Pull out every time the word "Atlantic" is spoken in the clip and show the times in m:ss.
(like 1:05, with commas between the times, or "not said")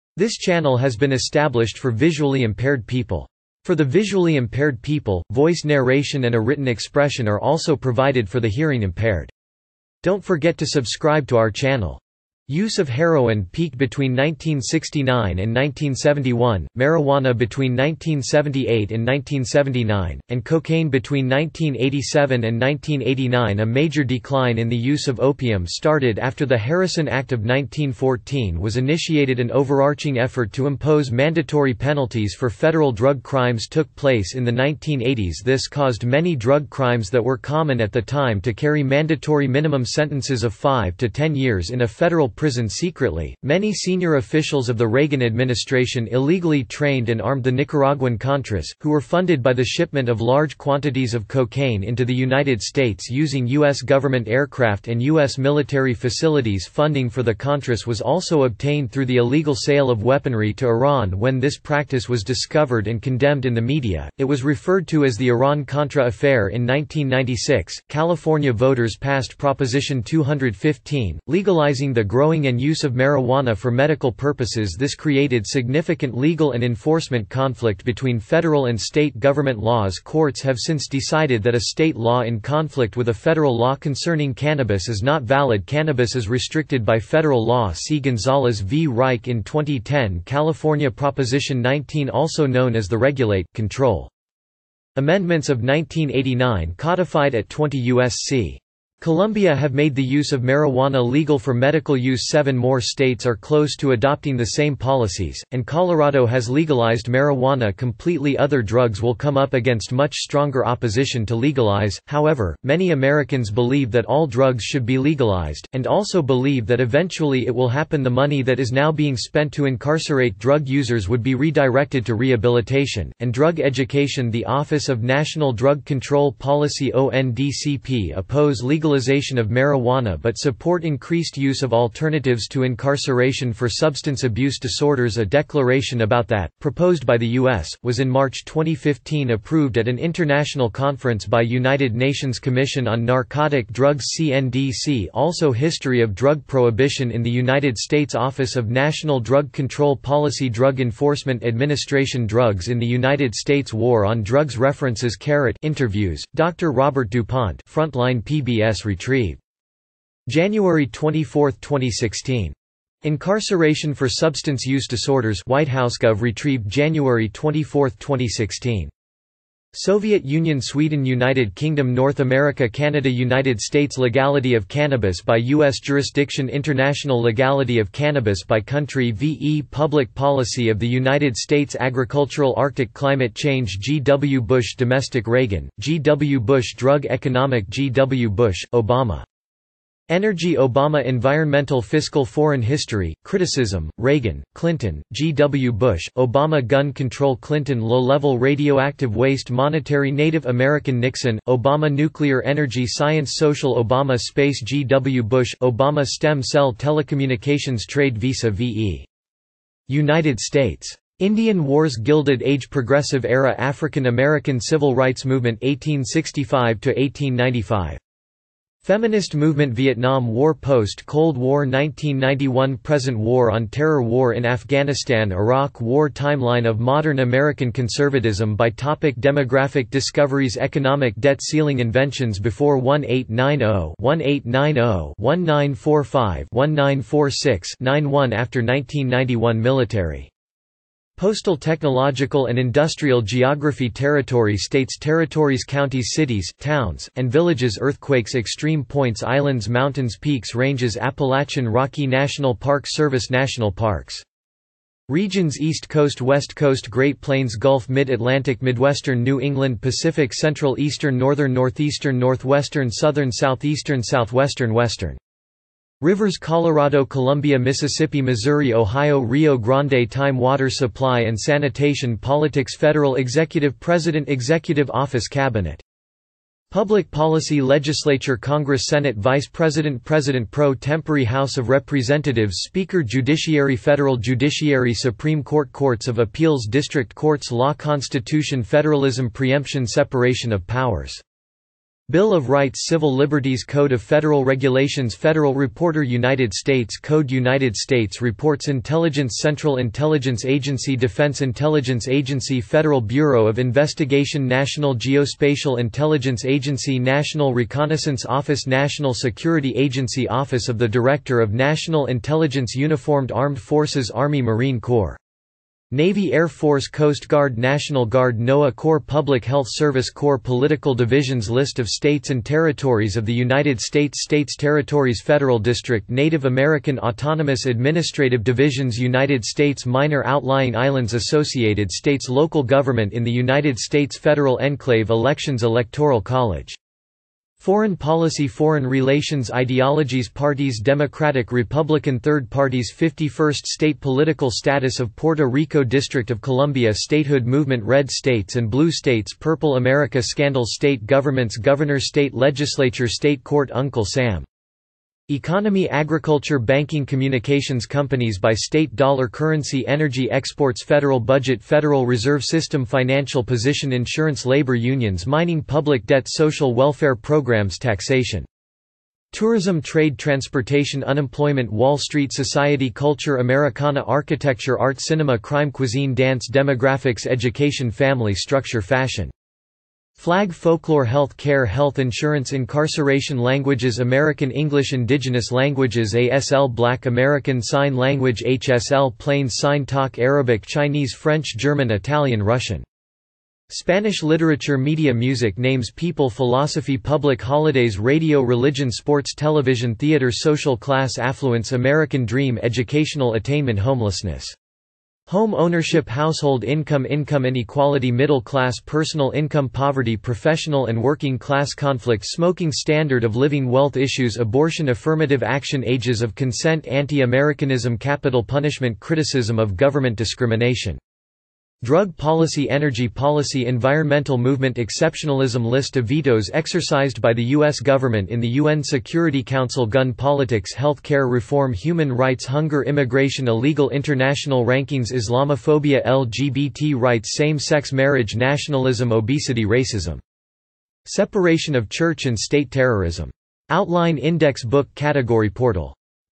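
4:17.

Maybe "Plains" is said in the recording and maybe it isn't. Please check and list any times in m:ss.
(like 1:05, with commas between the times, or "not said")
4:17, 6:29.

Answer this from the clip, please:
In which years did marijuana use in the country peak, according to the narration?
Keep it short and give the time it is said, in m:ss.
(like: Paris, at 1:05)
1978 to 1979, at 0:17.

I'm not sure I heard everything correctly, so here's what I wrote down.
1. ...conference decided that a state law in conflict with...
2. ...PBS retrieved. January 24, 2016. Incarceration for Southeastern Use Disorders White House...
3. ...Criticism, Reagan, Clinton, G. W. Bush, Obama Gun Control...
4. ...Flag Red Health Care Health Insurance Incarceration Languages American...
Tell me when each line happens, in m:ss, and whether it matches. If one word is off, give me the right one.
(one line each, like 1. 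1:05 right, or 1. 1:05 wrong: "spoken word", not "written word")
1. 1:20 wrong: "since", not "conference"
2. 2:38 wrong: "Substance", not "Southeastern"
3. 3:13 right
4. 6:20 wrong: "Folklore", not "Red".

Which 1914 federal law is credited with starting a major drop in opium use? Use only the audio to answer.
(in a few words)
Harrison Act.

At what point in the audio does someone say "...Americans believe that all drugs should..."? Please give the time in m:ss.
1:52.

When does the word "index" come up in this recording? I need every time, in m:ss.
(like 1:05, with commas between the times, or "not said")
7:24.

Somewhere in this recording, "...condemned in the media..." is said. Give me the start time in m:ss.
1:03.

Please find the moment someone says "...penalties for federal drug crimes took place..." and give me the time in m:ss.
0:31.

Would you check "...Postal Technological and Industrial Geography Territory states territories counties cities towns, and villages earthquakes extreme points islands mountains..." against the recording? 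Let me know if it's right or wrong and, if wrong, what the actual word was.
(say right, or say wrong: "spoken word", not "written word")
right.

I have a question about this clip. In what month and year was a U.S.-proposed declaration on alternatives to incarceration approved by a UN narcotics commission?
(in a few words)
March 2015.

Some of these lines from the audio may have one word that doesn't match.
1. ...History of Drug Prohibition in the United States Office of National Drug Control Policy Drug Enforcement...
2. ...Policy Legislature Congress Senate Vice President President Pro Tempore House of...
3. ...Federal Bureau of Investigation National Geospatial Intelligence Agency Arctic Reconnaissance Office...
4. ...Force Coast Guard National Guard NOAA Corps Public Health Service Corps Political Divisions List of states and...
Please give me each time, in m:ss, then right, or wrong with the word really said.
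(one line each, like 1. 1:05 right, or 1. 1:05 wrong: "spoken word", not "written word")
1. 2:25 right
2. 4:37 right
3. 5:02 wrong: "National", not "Arctic"
4. 5:16 right.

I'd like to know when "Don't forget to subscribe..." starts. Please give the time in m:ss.
0:10.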